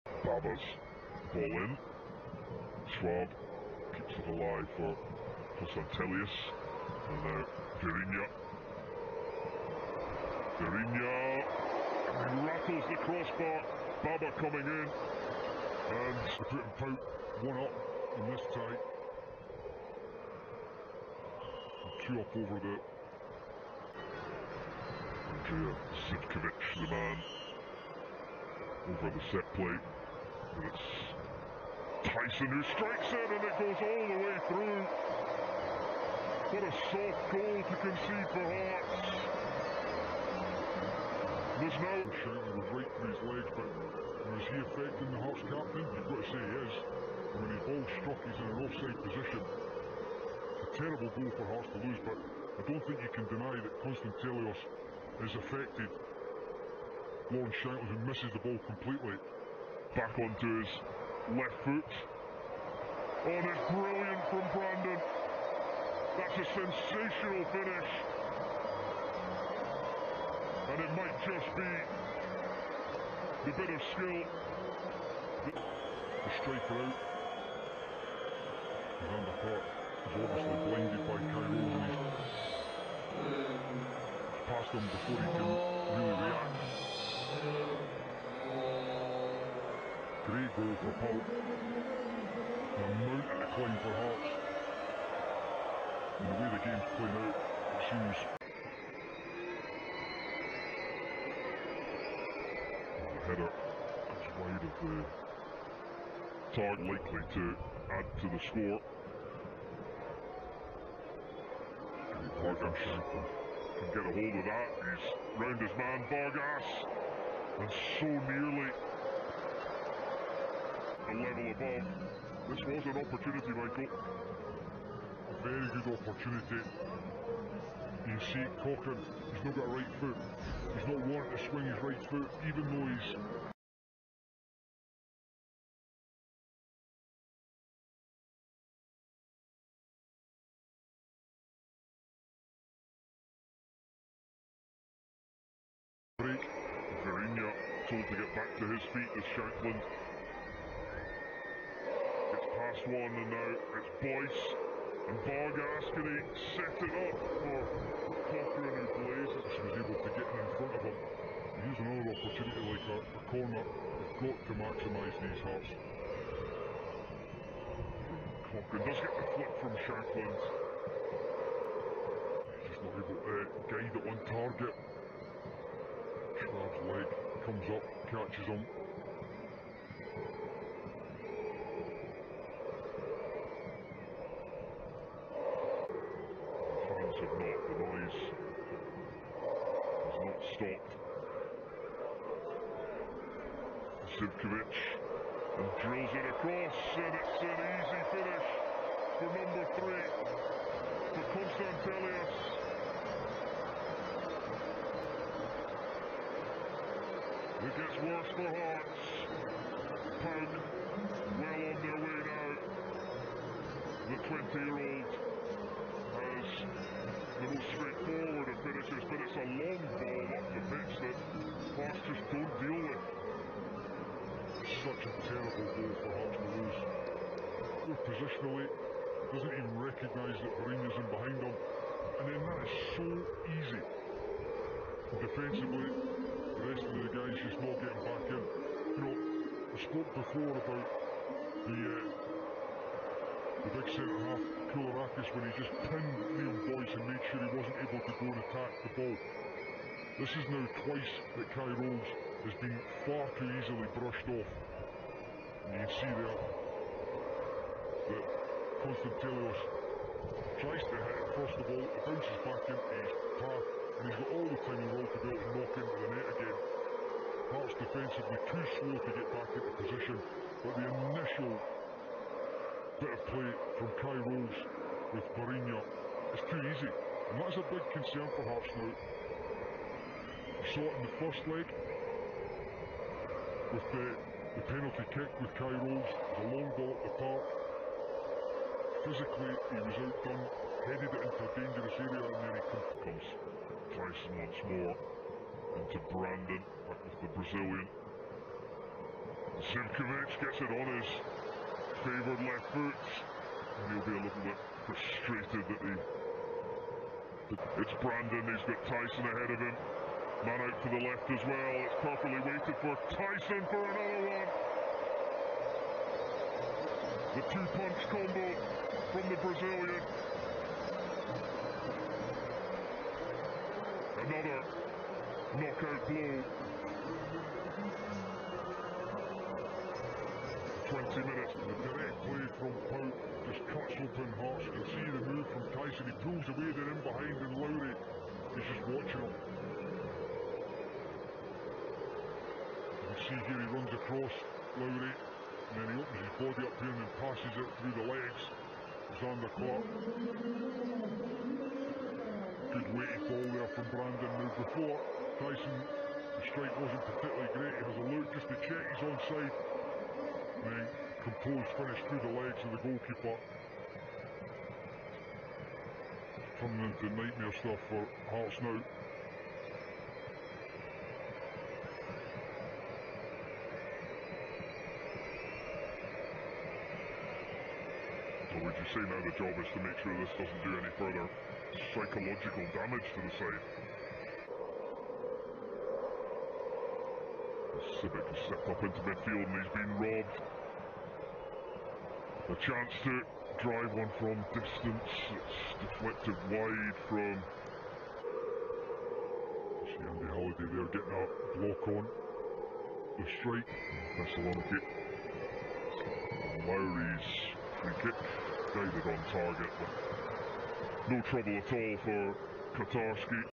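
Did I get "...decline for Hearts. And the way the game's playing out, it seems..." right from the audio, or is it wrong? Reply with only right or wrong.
right.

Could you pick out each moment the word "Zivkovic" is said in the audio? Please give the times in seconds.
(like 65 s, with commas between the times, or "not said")
26 s, 194 s, 299 s.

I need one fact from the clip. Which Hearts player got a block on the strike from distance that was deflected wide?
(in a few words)
Andy Halliday.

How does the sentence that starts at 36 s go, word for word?
What a soft goal to concede for Hearts.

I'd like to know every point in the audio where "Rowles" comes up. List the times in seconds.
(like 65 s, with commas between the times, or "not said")
251 s, 274 s, 285 s.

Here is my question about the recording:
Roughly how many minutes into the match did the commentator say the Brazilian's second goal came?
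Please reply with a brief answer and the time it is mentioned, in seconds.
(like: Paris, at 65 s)
20, at 330 s.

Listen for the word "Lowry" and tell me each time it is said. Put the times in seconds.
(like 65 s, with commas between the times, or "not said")
337 s, 344 s, 406 s.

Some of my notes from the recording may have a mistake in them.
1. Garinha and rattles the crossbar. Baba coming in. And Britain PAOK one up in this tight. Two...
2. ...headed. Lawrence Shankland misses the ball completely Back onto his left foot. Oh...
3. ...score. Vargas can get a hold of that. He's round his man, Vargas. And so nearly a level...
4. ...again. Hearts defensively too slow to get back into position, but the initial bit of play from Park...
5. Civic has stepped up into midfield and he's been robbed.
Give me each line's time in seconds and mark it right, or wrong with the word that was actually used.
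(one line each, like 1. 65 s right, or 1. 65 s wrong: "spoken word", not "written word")
1. 10 s right
2. 55 s wrong: "affected", not "headed"
3. 108 s right
4. 266 s wrong: "Kye", not "Park"
5. 388 s right.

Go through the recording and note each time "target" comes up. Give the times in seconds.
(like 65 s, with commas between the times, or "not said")
106 s, 174 s, 409 s.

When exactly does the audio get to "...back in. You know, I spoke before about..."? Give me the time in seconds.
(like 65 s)
238 s.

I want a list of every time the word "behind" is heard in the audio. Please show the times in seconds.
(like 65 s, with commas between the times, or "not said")
231 s, 337 s.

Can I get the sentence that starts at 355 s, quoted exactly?
Taison, the strike wasn't particularly great.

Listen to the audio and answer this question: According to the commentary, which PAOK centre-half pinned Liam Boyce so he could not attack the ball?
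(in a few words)
Koulierakis.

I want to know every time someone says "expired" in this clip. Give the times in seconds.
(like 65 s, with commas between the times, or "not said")
not said.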